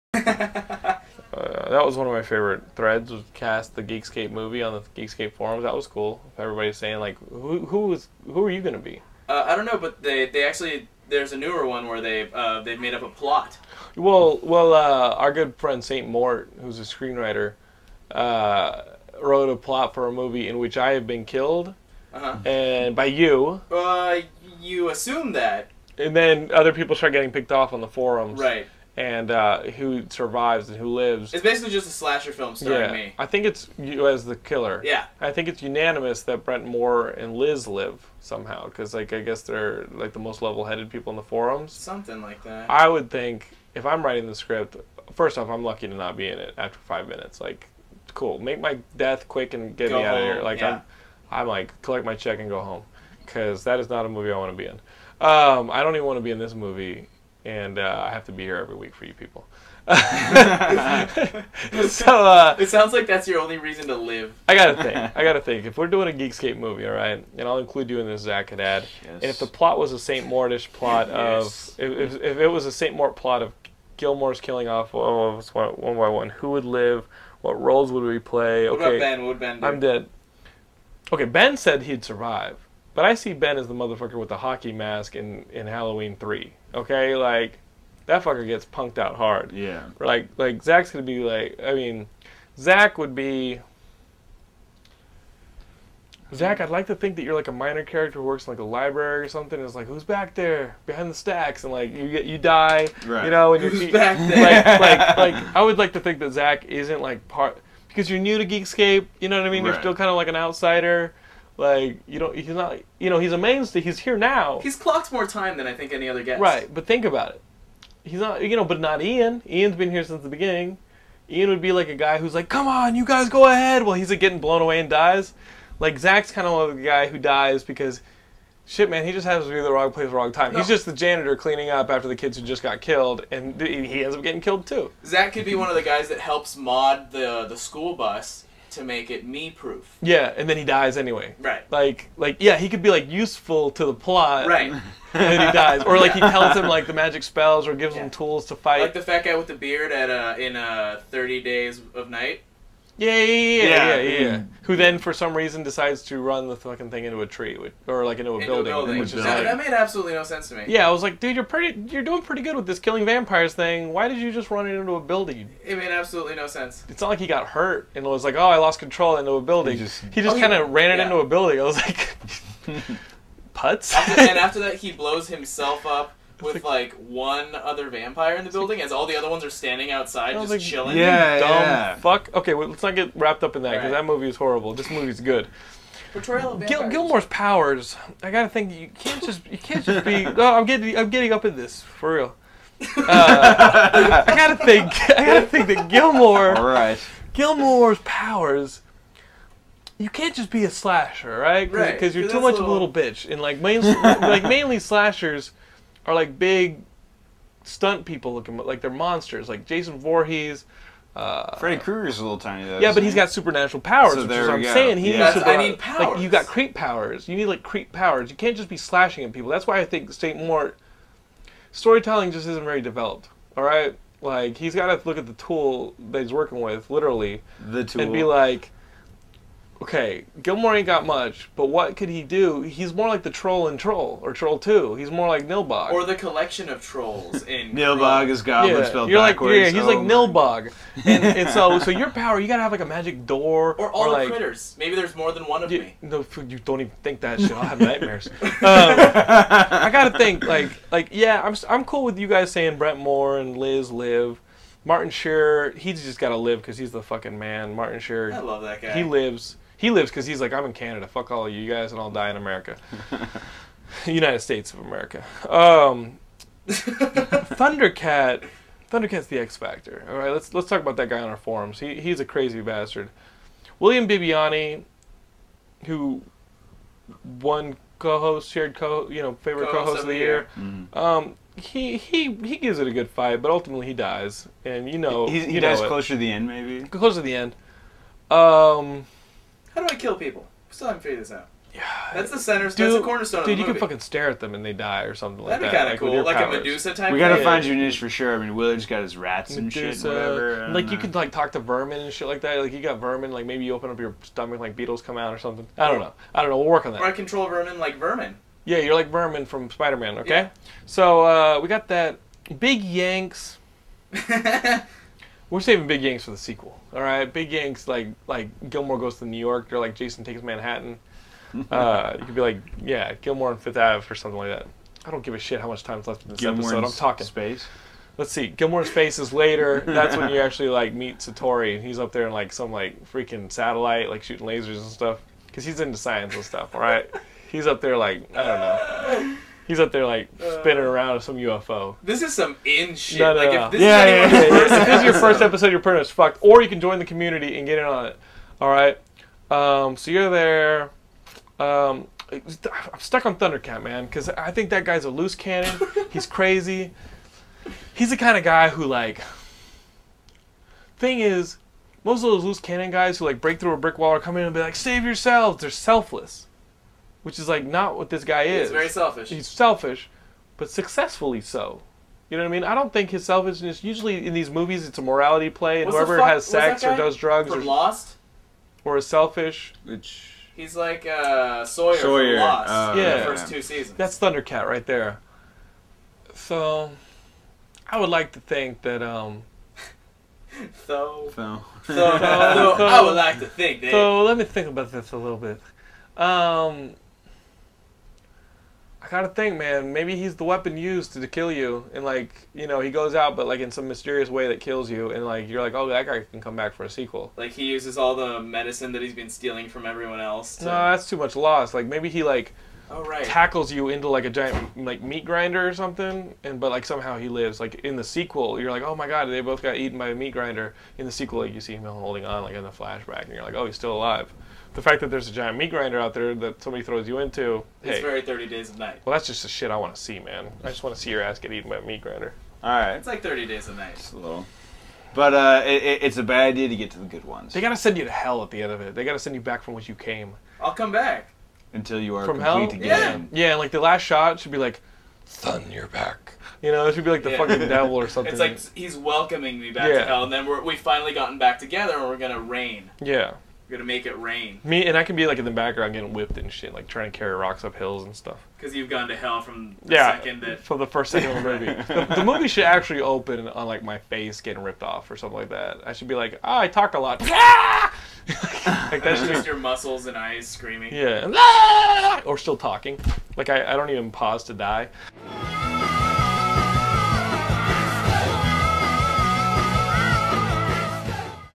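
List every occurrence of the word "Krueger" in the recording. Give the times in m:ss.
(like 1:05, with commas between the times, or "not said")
3:31.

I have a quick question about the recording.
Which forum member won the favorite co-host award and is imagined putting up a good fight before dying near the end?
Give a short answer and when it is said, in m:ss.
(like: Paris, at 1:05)
William Bibiani, at 4:33.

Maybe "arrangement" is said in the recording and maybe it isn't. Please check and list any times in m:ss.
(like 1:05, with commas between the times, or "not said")
not said.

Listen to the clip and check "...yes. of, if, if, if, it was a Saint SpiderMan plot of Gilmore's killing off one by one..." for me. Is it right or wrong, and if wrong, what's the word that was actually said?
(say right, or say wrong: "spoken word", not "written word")
wrong: "Mort", not "SpiderMan".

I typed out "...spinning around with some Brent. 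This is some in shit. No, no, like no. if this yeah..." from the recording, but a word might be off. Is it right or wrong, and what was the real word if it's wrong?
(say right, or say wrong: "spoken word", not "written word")
wrong: "UFO", not "Brent".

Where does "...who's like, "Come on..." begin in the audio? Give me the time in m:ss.
2:02.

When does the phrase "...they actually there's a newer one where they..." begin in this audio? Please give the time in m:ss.
0:10.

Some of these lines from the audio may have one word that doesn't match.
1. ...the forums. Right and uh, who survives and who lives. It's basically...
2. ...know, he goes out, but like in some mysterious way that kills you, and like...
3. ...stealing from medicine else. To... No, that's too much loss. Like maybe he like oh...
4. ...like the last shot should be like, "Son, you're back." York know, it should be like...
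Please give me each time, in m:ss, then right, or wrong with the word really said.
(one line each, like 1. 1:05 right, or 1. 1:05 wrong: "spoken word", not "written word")
1. 0:27 right
2. 6:42 right
3. 6:49 wrong: "everyone", not "medicine"
4. 7:23 wrong: "You", not "York".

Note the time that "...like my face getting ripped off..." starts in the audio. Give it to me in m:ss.
7:43.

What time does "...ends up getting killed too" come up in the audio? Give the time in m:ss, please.
2:14.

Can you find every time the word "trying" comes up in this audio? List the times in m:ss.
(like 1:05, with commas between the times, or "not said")
7:36.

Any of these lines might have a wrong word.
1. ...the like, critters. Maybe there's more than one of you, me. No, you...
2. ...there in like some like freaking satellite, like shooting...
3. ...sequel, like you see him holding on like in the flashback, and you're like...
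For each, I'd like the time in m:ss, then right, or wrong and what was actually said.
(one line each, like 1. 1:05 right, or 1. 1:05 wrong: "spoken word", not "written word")
1. 4:04 right
2. 5:32 right
3. 7:01 right.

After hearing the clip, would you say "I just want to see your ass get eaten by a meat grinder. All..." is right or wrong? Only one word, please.
right.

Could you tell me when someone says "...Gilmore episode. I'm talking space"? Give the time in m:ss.
5:26.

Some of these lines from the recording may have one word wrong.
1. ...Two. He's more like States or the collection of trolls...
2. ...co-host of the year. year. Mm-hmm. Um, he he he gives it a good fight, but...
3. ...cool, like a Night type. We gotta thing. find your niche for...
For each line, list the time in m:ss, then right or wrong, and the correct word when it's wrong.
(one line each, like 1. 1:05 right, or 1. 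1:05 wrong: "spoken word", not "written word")
1. 3:54 wrong: "Nilbog", not "States"
2. 4:39 right
3. 4:56 wrong: "Medusa", not "Night".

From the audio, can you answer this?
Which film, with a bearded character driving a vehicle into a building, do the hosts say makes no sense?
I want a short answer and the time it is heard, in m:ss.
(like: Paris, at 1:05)
Thirty Days of Night, at 2:31.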